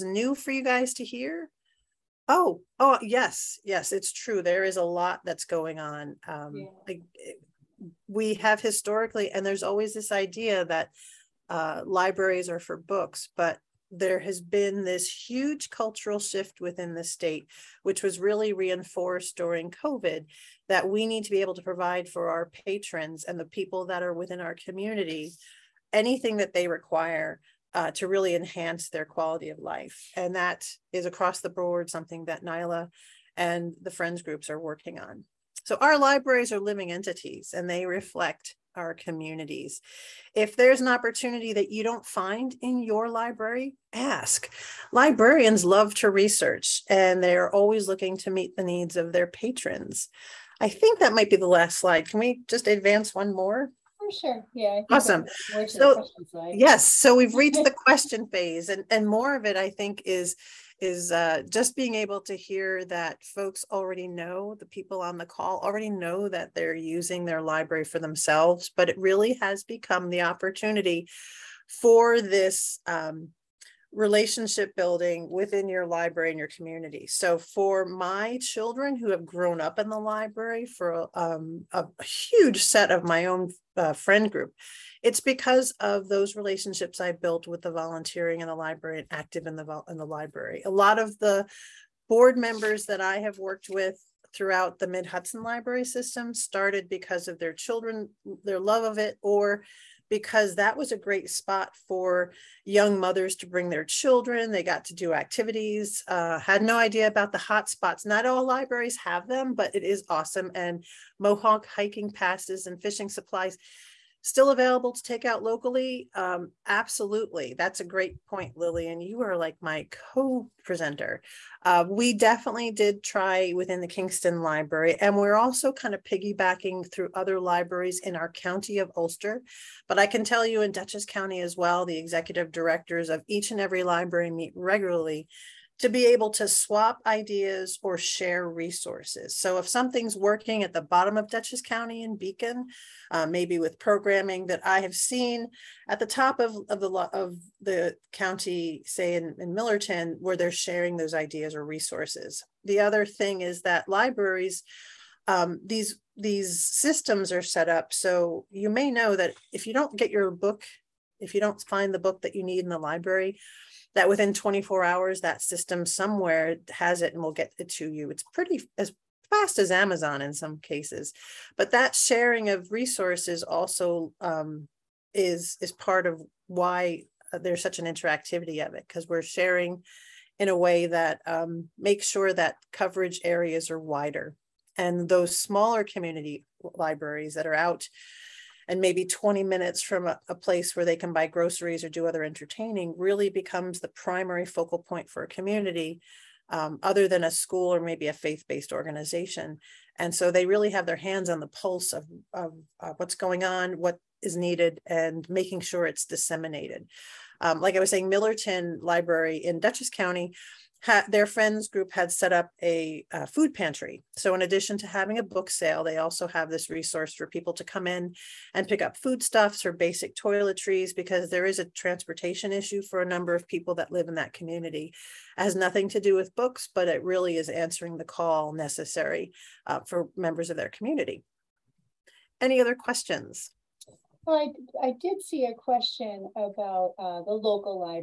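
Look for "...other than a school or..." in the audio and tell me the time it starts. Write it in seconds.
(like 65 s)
196 s.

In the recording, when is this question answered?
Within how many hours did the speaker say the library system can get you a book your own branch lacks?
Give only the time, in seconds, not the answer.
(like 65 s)
164 s.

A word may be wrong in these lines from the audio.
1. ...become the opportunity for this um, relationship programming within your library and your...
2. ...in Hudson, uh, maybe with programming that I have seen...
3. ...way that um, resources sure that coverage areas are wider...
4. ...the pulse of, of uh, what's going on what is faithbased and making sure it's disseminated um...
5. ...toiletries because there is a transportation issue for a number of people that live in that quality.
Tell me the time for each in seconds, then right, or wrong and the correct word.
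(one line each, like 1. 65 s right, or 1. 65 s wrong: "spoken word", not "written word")
1. 69 s wrong: "building", not "programming"
2. 142 s wrong: "Beacon", not "Hudson"
3. 180 s wrong: "makes", not "resources"
4. 201 s wrong: "needed", not "faithbased"
5. 220 s wrong: "community", not "quality".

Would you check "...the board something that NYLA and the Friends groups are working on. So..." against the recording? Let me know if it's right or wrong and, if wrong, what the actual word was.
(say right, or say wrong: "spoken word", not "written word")
right.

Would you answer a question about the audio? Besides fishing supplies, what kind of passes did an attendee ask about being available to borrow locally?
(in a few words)
Mohonk hiking passes.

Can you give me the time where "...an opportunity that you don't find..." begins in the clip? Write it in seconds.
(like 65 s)
40 s.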